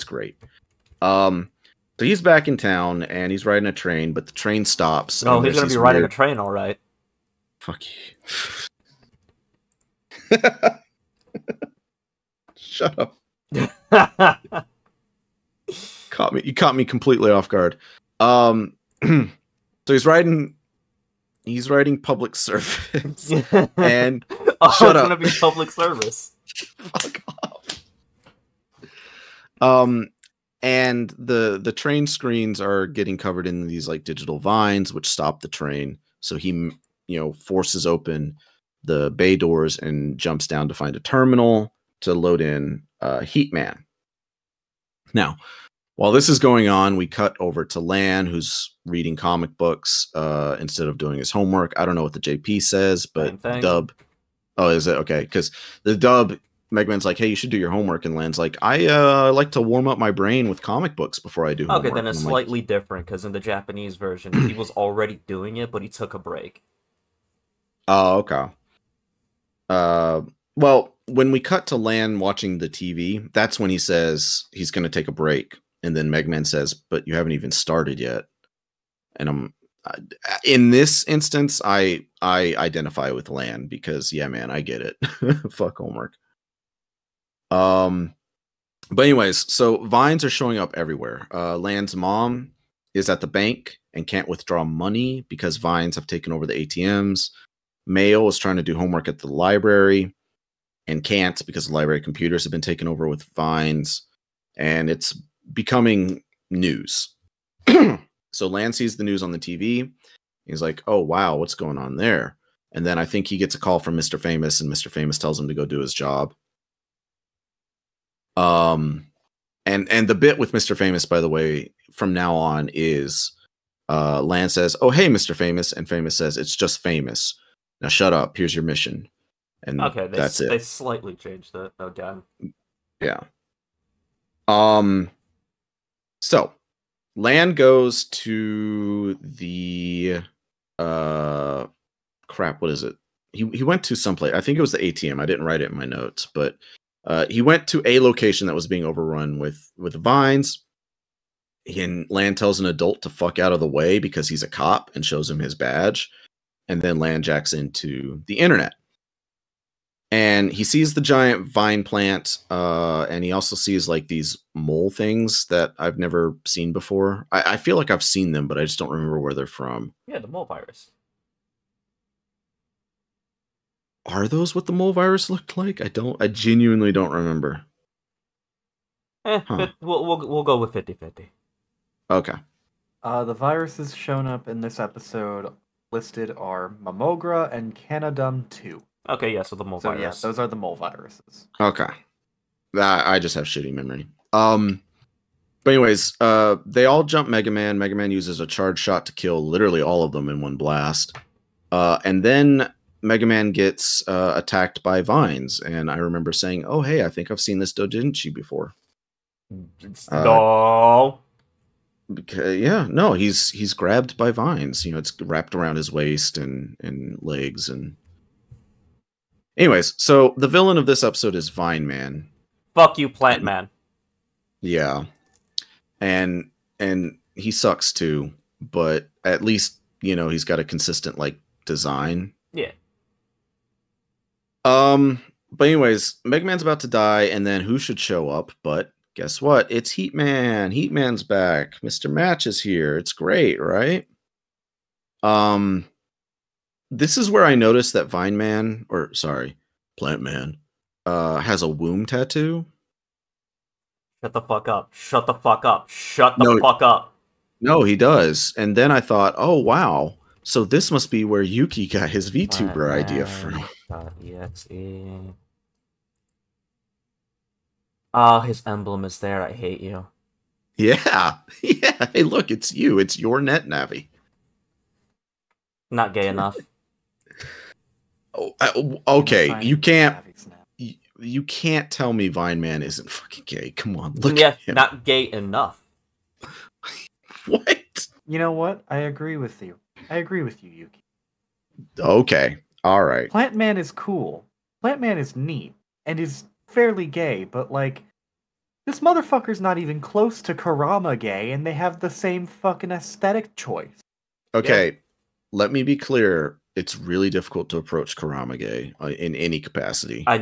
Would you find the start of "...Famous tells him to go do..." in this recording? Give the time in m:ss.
1:54.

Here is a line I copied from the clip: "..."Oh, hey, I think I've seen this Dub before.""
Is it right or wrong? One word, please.
wrong.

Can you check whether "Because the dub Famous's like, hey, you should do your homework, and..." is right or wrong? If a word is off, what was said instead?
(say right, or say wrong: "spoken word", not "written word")
wrong: "Megman", not "Famous".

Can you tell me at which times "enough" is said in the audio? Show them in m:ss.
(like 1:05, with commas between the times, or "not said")
4:36, 4:45.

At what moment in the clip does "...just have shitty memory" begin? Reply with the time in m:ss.
3:13.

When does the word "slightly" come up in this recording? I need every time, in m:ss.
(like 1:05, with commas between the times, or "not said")
1:02, 2:10.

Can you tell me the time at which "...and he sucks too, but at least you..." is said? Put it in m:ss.
3:46.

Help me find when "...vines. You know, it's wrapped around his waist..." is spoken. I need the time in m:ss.
3:34.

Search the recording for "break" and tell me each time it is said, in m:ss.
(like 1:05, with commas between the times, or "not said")
1:06, 1:15.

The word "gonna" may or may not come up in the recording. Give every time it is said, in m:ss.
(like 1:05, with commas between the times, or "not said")
0:05, 0:25.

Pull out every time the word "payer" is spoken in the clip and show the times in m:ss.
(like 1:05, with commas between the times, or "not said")
not said.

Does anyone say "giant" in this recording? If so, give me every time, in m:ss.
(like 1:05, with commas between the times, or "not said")
2:41.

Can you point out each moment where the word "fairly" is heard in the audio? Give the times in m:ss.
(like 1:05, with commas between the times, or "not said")
4:56.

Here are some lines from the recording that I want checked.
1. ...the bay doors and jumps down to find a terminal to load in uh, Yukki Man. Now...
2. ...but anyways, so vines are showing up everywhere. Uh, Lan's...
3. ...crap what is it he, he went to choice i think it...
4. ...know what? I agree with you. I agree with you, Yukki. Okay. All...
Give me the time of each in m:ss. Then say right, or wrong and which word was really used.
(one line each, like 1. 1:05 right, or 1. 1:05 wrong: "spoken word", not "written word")
1. 0:38 wrong: "Heat", not "Yukki"
2. 1:28 right
3. 2:22 wrong: "someplace", not "choice"
4. 4:48 right.